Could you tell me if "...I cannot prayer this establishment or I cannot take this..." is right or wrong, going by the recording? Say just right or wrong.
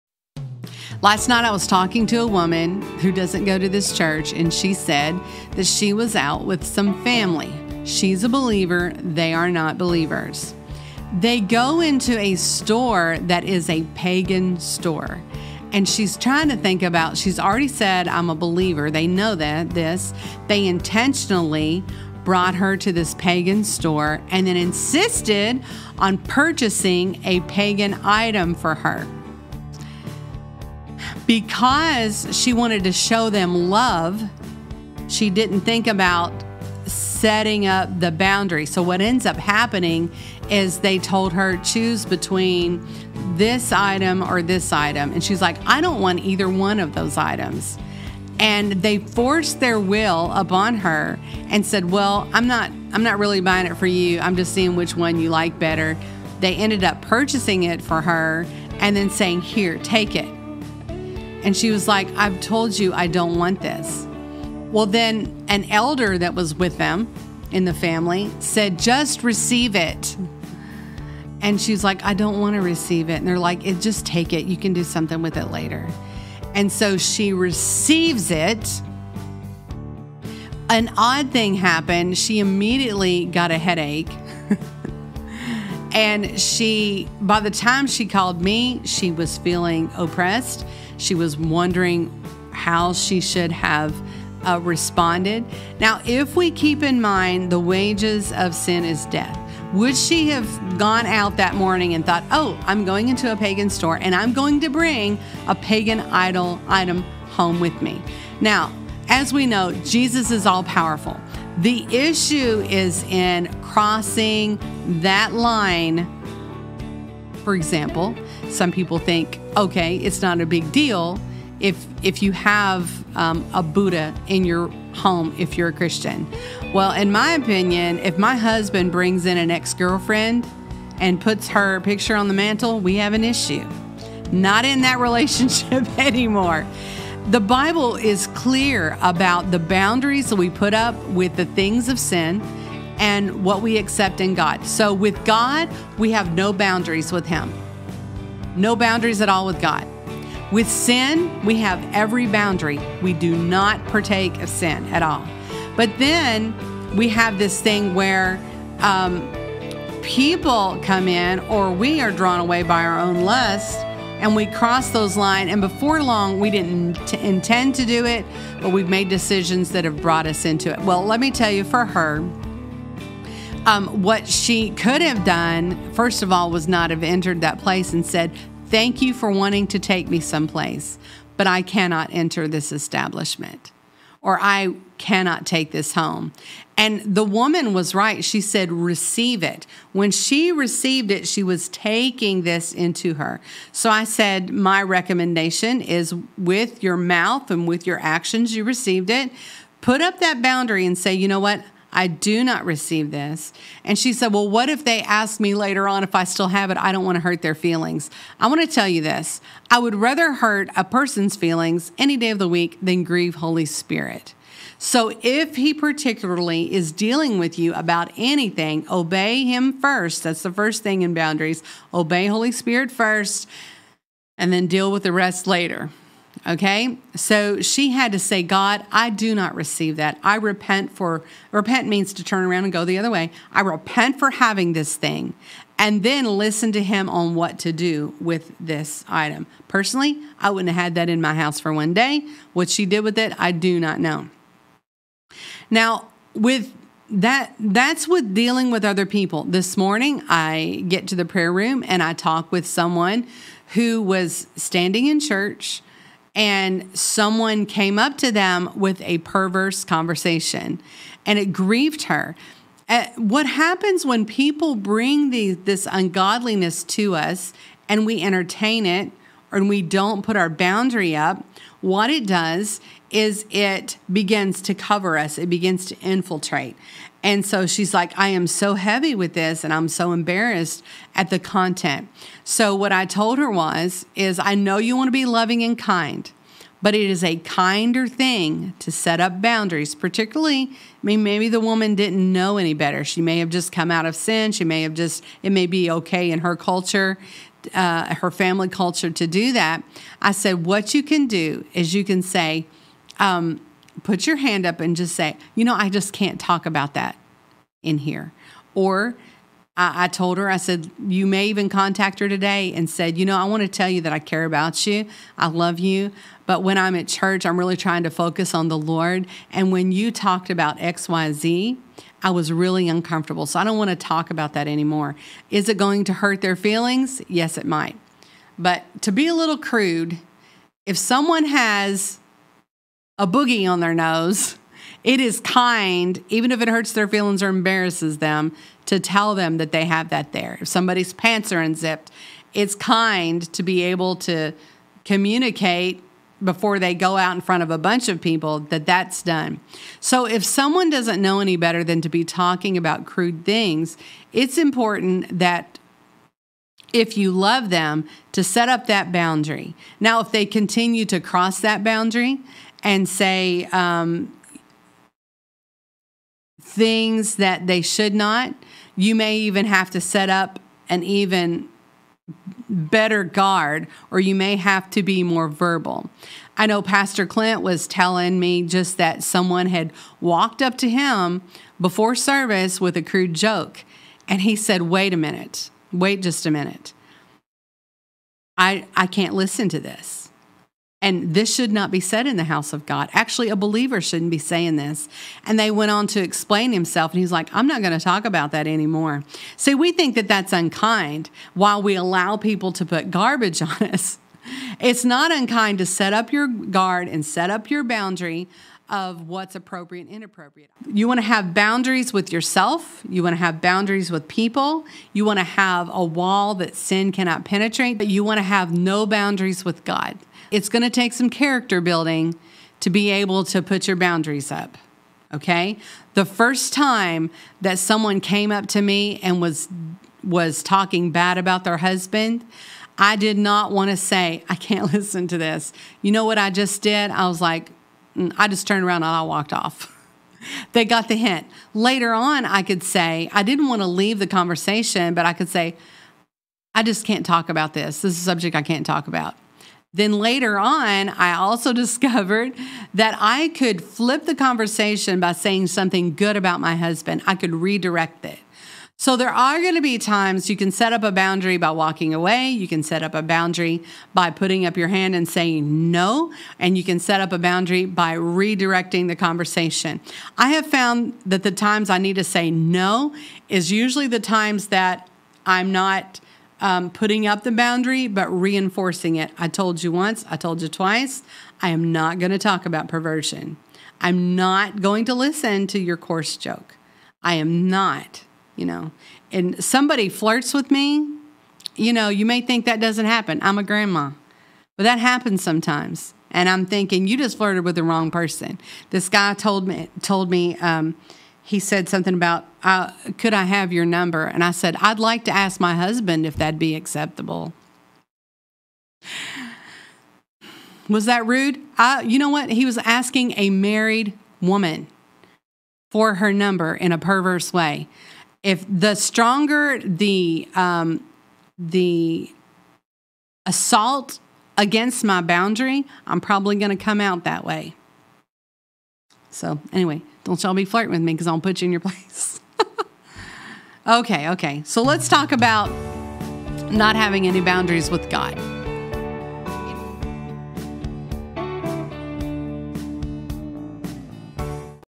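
wrong.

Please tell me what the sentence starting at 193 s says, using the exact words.
So I said, My recommendation is with your mouth and with your actions, you received it.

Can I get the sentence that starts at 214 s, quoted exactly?
So if he particularly is dealing with you about anything, obey him first.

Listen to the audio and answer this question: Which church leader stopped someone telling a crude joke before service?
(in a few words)
Pastor Clint.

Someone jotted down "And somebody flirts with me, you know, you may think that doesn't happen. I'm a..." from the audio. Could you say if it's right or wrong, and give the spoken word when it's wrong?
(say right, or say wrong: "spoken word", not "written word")
right.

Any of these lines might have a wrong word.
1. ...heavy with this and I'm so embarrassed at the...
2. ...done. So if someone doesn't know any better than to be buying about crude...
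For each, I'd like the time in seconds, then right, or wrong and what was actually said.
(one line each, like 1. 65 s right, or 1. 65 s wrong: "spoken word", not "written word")
1. 278 s right
2. 349 s wrong: "talking", not "buying".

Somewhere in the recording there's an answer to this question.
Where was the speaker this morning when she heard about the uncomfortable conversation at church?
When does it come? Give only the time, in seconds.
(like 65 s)
251 s.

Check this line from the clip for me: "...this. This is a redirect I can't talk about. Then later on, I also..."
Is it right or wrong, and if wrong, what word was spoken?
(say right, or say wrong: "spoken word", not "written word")
wrong: "subject", not "redirect".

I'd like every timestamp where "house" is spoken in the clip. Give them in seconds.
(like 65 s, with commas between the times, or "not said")
241 s, 392 s.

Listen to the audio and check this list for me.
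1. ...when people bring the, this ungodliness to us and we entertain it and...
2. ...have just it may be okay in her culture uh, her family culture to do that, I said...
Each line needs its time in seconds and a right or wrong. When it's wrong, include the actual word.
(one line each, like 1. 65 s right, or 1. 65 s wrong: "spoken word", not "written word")
1. 264 s right
2. 294 s right.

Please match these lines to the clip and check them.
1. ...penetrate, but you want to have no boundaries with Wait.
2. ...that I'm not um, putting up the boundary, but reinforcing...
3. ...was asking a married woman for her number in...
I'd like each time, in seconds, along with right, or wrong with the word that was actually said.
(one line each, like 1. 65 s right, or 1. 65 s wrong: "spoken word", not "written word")
1. 417 s wrong: "God", not "Wait"
2. 474 s right
3. 512 s right.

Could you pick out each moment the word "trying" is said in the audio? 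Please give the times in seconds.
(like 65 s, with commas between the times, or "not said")
16 s, 317 s.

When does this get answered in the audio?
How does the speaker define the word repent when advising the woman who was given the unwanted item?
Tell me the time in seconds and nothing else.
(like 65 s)
232 s.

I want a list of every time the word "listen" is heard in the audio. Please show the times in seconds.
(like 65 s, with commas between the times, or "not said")
236 s, 389 s, 434 s, 485 s.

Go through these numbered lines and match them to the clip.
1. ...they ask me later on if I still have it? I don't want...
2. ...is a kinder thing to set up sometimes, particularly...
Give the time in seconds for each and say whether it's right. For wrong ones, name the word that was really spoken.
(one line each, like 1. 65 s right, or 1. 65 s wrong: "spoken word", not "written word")
1. 204 s right
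2. 287 s wrong: "boundaries", not "sometimes".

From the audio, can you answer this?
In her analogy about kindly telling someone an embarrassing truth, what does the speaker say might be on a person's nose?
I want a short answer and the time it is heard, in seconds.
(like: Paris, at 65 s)
A boogie, at 333 s.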